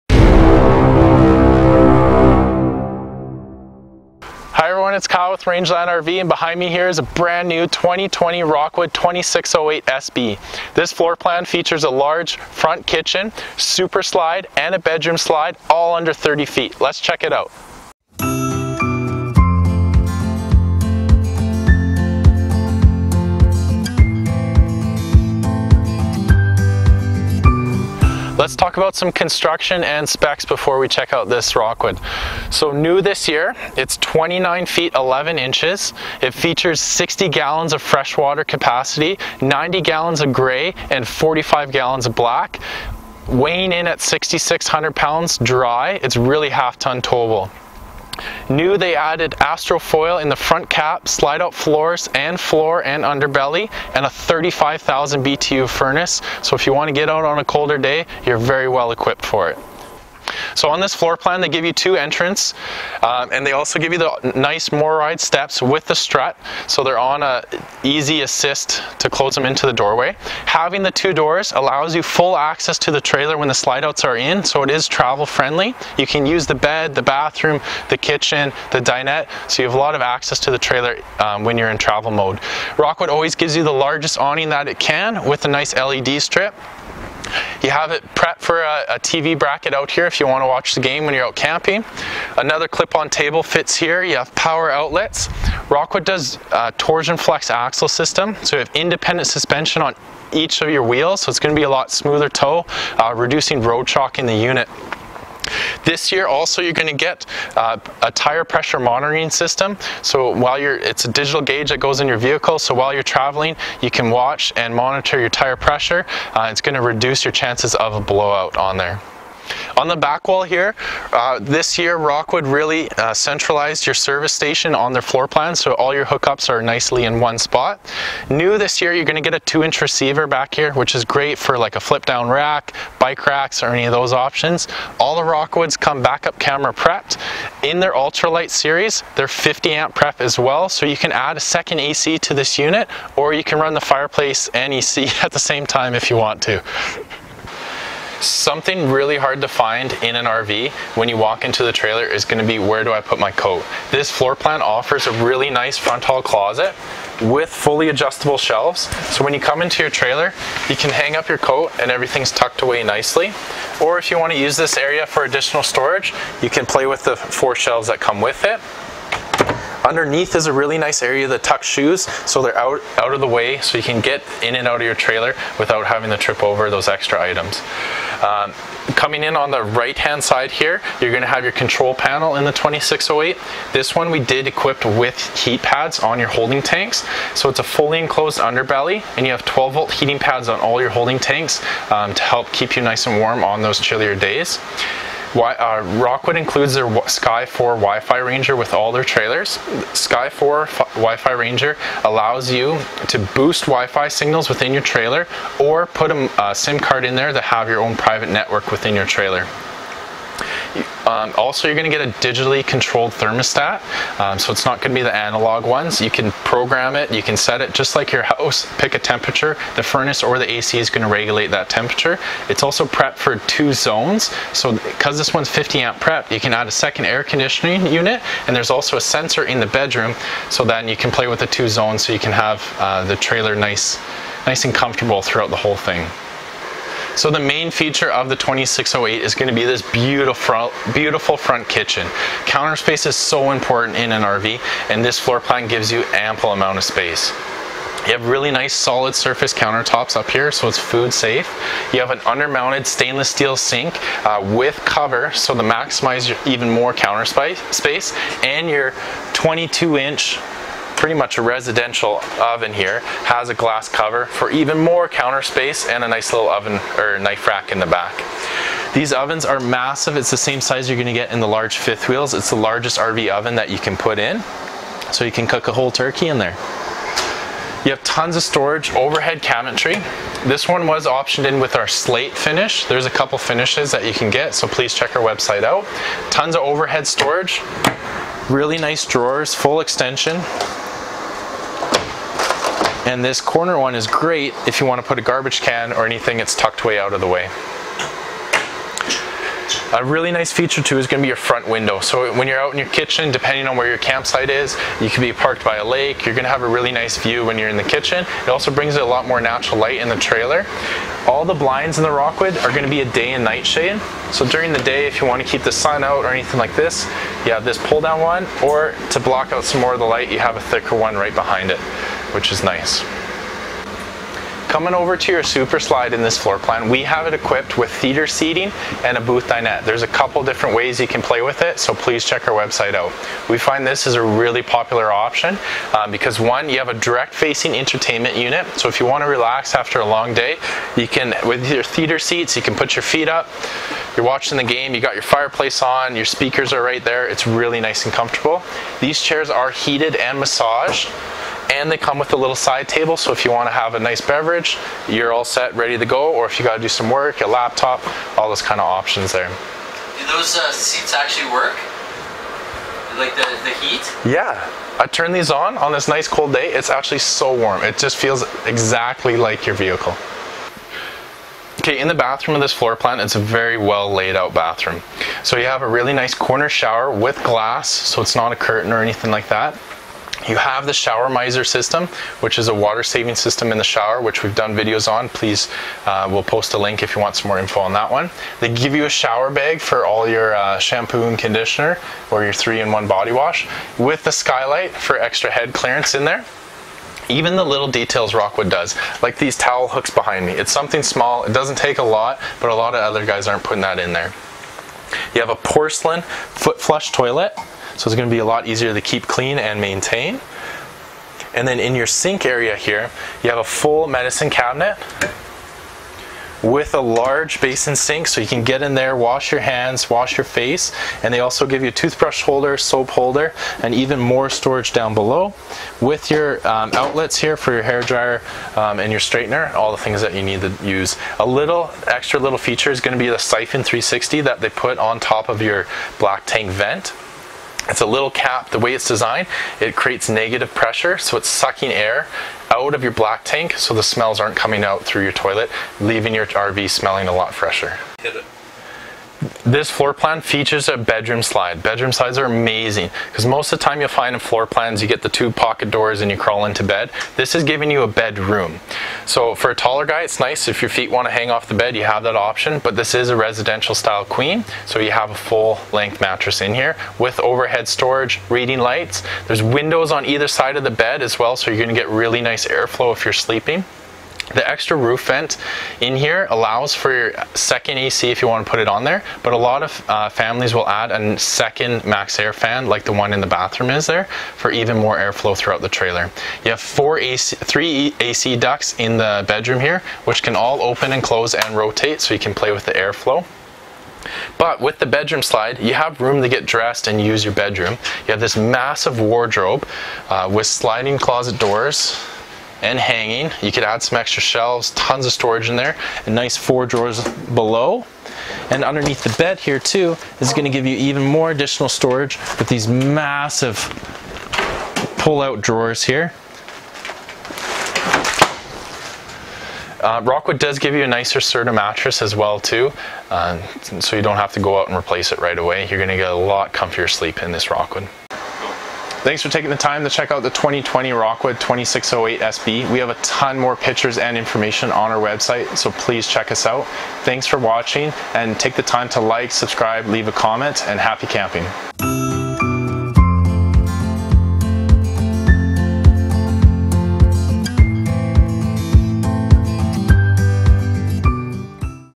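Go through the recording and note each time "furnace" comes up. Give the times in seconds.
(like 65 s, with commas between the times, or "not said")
55 s, 219 s.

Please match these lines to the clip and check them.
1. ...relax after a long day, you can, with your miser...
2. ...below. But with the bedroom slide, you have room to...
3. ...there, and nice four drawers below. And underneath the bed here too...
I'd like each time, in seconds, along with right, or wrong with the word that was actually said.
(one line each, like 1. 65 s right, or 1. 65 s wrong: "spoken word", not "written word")
1. 339 s wrong: "theater", not "miser"
2. 492 s wrong: "airflow", not "below"
3. 505 s right.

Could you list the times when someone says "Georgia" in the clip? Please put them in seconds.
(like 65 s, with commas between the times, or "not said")
not said.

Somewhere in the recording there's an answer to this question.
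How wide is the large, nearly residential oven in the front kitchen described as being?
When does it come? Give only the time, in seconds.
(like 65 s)
259 s.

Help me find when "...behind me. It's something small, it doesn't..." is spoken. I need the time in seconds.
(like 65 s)
400 s.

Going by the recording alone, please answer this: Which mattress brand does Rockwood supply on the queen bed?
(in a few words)
Serta.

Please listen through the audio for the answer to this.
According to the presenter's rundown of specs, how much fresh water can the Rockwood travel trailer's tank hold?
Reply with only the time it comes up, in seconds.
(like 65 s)
36 s.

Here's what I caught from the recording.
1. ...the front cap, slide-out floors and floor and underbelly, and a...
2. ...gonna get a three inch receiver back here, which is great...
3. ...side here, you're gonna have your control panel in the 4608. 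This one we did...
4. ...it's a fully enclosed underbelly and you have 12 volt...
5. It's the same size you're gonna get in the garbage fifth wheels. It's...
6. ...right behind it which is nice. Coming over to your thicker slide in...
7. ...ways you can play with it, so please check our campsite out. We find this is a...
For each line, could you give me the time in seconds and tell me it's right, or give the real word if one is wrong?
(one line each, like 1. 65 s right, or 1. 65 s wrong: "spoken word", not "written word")
1. 50 s right
2. 129 s wrong: "two", not "three"
3. 180 s wrong: "2608", not "4608"
4. 187 s right
5. 270 s wrong: "large", not "garbage"
6. 321 s wrong: "super", not "thicker"
7. 330 s wrong: "website", not "campsite".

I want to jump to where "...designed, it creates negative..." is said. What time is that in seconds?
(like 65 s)
439 s.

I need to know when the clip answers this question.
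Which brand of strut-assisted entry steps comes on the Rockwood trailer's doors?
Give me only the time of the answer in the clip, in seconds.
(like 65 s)
64 s.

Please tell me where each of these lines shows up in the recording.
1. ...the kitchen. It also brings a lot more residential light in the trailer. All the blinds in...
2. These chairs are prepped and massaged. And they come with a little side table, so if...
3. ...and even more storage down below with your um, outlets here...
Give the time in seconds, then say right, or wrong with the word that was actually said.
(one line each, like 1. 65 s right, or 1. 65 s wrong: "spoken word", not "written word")
1. 307 s wrong: "natural", not "residential"
2. 349 s wrong: "heated", not "prepped"
3. 423 s right.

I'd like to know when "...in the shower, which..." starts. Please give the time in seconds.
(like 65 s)
383 s.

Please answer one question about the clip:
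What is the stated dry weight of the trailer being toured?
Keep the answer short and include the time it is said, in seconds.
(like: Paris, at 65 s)
6,600 pounds, at 44 s.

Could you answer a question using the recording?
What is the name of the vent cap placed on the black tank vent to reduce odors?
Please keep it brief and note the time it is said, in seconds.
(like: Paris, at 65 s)
siphon 360, at 433 s.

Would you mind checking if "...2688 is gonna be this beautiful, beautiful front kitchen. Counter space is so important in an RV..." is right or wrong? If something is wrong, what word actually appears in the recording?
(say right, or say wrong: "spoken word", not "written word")
wrong: "2608", not "2688".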